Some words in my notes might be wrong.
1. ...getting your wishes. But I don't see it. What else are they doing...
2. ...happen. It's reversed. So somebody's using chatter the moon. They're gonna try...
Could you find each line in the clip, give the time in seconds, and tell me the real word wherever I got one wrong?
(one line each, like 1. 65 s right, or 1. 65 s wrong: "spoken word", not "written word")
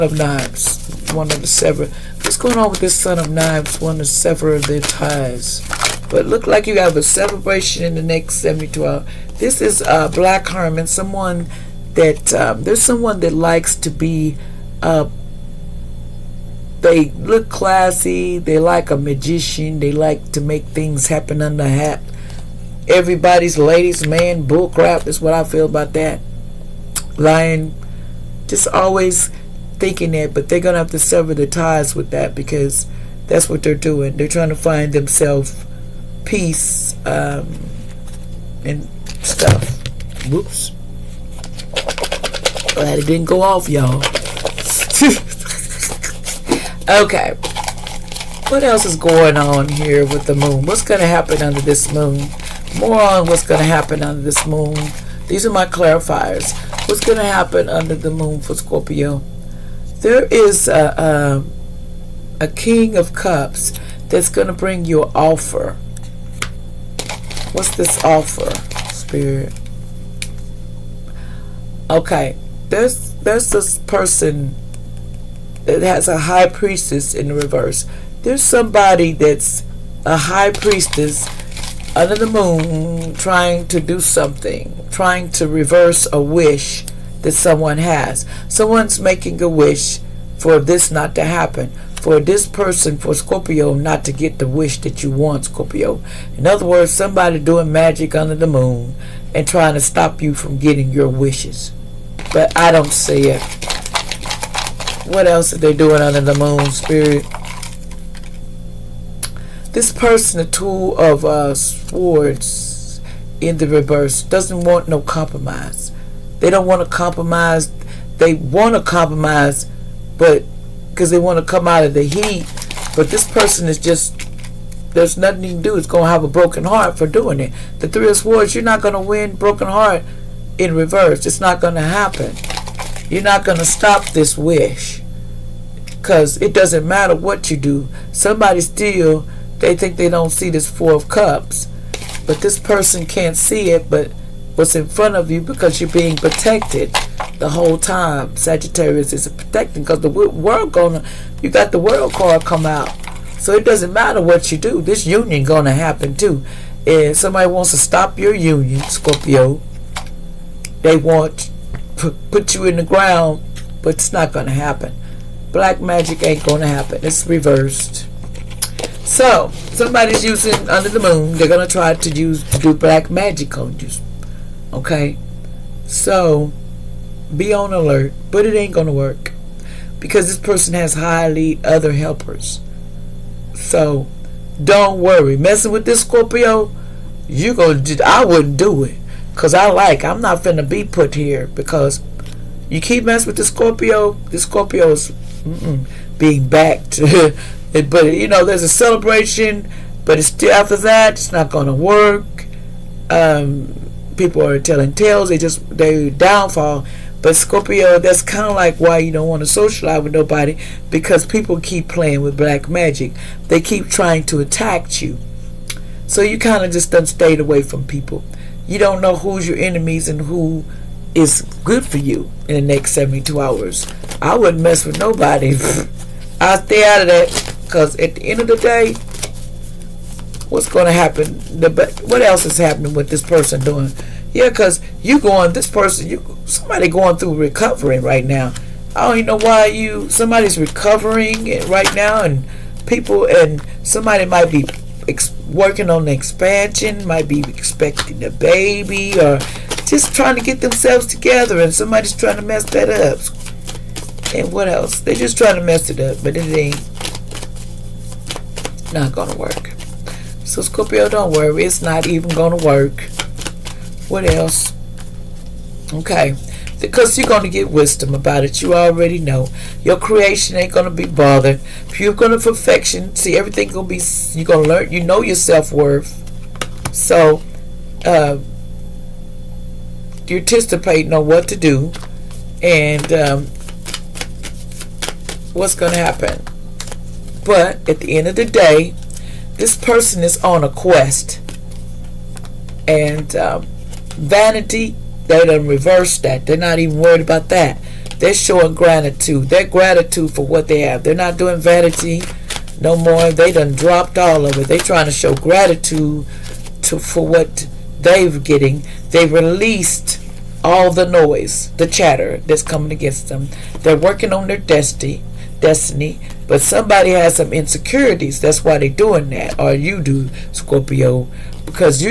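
1. 100 s right
2. 166 s wrong: "under", not "chatter".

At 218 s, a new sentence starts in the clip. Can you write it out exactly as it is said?
You don't know who's your enemies and who is good for you in the next 72 hours.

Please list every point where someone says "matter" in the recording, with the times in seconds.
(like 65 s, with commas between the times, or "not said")
136 s, 153 s.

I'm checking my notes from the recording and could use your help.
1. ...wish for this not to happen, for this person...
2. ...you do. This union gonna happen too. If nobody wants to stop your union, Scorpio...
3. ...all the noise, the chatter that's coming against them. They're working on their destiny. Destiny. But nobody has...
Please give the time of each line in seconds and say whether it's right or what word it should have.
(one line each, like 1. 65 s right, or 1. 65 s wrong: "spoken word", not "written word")
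1. 89 s right
2. 154 s wrong: "somebody", not "nobody"
3. 310 s wrong: "somebody", not "nobody".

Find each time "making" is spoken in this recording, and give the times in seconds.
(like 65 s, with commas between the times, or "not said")
88 s.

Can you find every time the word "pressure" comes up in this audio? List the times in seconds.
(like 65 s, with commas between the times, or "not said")
not said.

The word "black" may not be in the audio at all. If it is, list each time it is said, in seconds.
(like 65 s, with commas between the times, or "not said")
10 s, 165 s, 172 s, 212 s.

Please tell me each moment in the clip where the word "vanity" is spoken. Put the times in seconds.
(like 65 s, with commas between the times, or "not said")
294 s, 301 s.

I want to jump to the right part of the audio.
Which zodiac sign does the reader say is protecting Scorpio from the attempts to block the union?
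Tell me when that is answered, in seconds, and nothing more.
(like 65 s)
148 s.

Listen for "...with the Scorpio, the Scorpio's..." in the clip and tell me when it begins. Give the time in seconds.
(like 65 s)
193 s.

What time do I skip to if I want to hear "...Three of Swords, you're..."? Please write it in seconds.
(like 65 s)
127 s.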